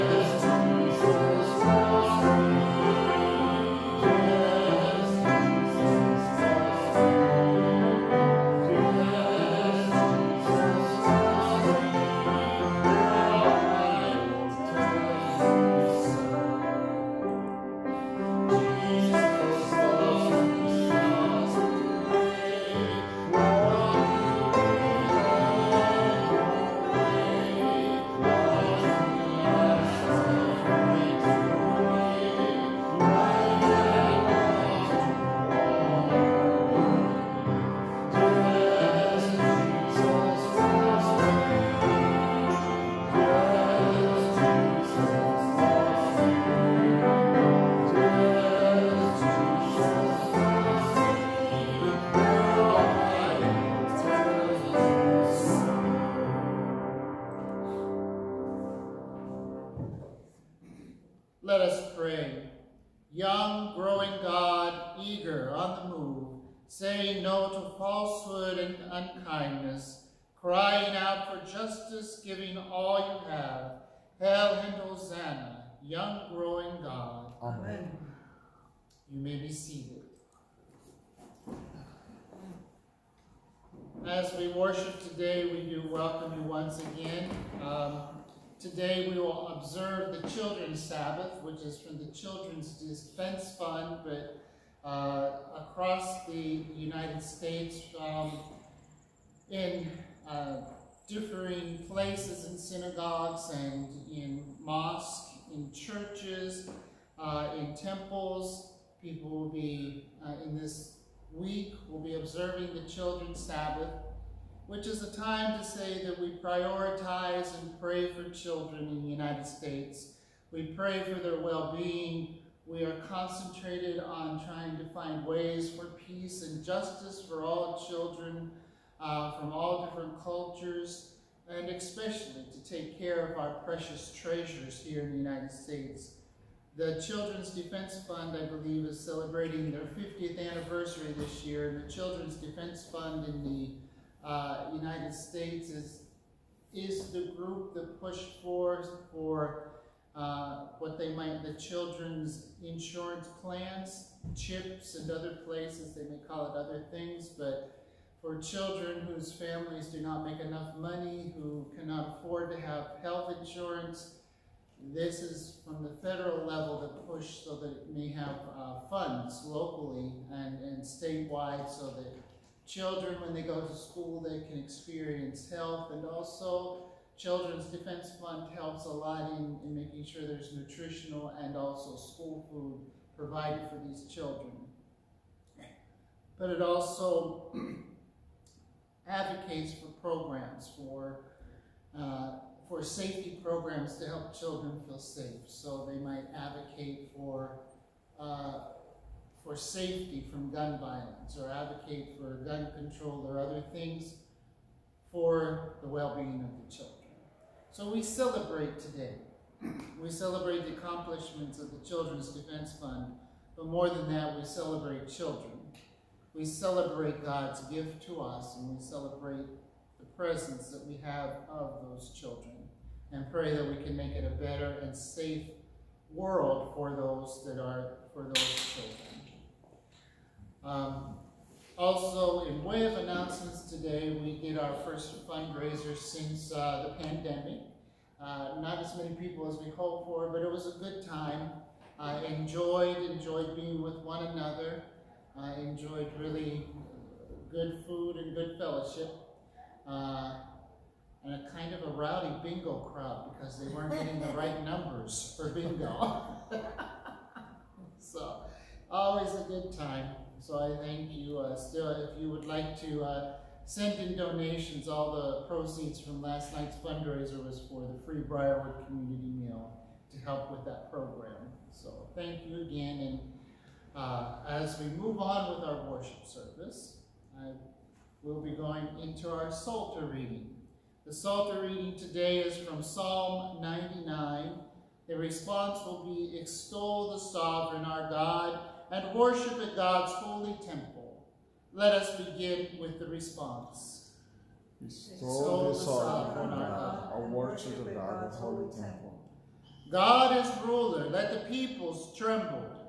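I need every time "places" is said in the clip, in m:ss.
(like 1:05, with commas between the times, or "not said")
1:41, 2:35.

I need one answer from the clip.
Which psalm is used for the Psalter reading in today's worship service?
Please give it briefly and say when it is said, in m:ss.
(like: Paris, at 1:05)
Psalm 99, at 4:42.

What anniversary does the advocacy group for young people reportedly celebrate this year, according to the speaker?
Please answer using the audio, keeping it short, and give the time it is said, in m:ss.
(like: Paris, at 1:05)
50th, at 2:19.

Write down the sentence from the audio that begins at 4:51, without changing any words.
Let us begin with the response.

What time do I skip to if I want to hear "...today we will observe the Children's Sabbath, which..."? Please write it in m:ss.
1:28.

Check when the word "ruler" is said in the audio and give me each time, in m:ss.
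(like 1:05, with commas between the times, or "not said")
5:00.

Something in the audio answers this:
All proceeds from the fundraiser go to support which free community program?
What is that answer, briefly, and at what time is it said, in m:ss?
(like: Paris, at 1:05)
Briarwood Community Meal, at 4:28.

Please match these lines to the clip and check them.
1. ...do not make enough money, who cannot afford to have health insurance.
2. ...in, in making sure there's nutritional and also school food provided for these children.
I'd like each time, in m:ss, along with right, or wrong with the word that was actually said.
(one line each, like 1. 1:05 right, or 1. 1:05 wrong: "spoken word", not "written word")
1. 2:39 right
2. 2:59 right.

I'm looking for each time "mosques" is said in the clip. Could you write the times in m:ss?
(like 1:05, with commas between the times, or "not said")
1:44.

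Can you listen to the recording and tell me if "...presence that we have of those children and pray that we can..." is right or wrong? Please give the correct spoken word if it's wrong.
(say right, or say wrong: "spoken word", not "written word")
right.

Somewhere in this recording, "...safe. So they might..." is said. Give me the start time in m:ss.
3:14.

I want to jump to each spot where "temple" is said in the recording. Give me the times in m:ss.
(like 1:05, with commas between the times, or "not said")
1:47, 4:50, 4:58.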